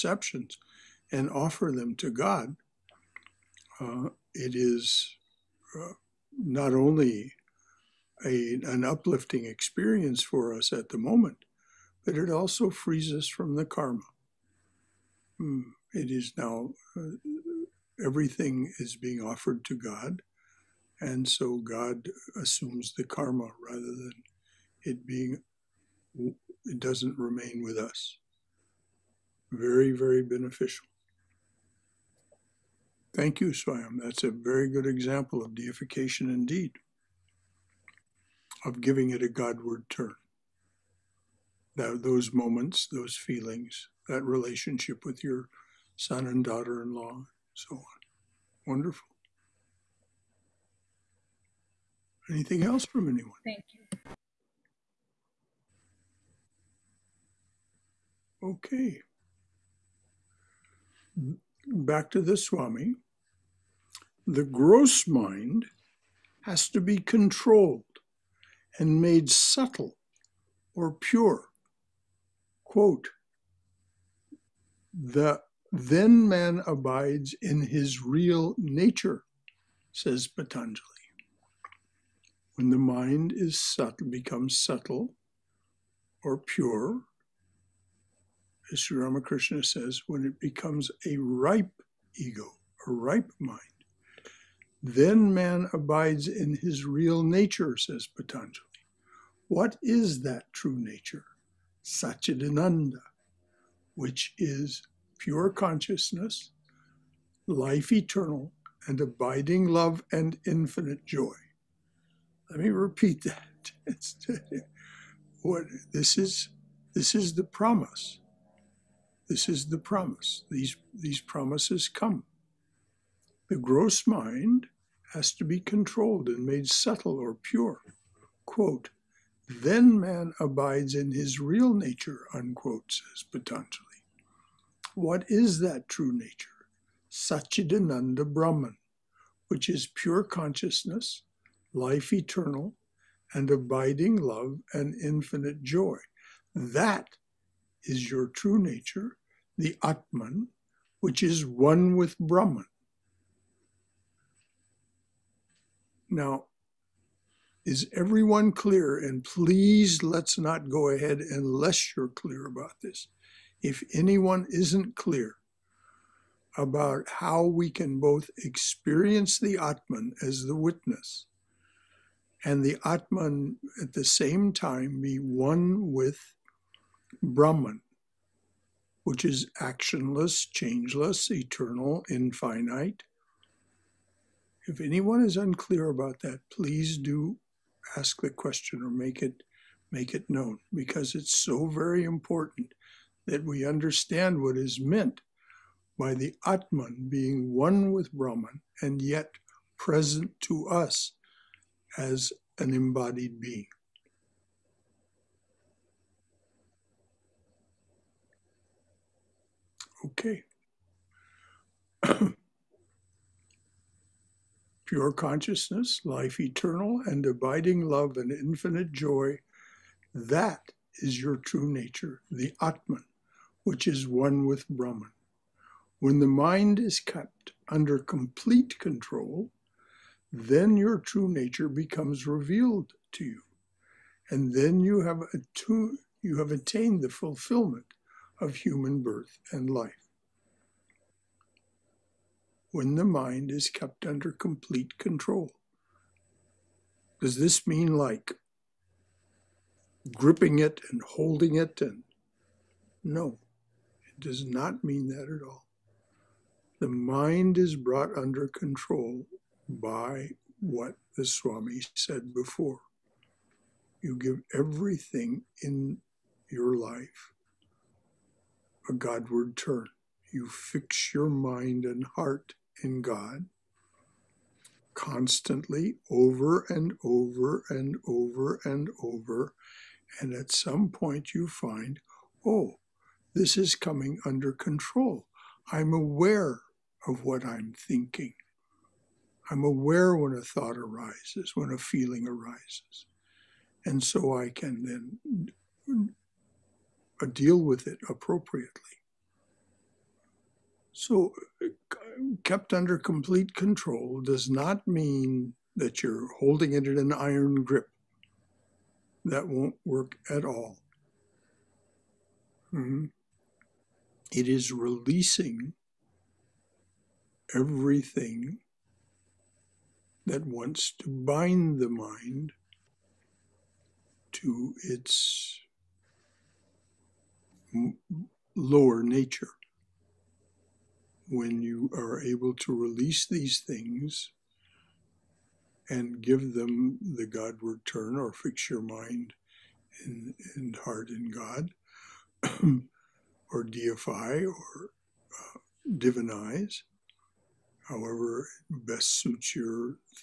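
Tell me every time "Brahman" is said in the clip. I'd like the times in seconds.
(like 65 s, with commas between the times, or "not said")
138 s, 152 s, 177 s, 198 s, 224 s.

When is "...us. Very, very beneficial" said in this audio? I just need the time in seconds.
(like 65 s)
27 s.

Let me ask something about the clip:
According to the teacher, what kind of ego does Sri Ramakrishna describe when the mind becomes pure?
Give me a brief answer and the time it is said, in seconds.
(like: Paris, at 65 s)
A ripe ego, at 91 s.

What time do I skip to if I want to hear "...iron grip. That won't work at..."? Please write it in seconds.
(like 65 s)
307 s.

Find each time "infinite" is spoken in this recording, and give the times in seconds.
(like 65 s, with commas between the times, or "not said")
110 s, 144 s, 182 s, 218 s.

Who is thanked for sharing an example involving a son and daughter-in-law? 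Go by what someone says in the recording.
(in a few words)
Swayam.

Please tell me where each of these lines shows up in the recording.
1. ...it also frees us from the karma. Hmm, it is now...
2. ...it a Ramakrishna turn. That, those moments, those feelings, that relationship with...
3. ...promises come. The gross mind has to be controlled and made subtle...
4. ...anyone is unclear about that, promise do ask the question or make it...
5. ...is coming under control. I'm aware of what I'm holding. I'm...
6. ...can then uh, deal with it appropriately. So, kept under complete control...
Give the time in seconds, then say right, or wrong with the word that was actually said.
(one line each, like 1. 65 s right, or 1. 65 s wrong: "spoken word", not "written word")
1. 12 s right
2. 39 s wrong: "Godward", not "Ramakrishna"
3. 121 s right
4. 184 s wrong: "please", not "promise"
5. 283 s wrong: "thinking", not "holding"
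6. 294 s right.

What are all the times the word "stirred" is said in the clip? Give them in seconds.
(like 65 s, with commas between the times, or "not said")
not said.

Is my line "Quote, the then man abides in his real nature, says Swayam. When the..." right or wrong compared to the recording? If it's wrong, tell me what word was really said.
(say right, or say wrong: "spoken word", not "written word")
wrong: "Patanjali", not "Swayam".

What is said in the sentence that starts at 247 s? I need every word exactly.
Does this mean like gripping it and holding it?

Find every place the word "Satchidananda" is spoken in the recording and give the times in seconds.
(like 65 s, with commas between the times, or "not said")
101 s, 137 s.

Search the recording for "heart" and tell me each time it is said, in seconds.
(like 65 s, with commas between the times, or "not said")
272 s, 340 s.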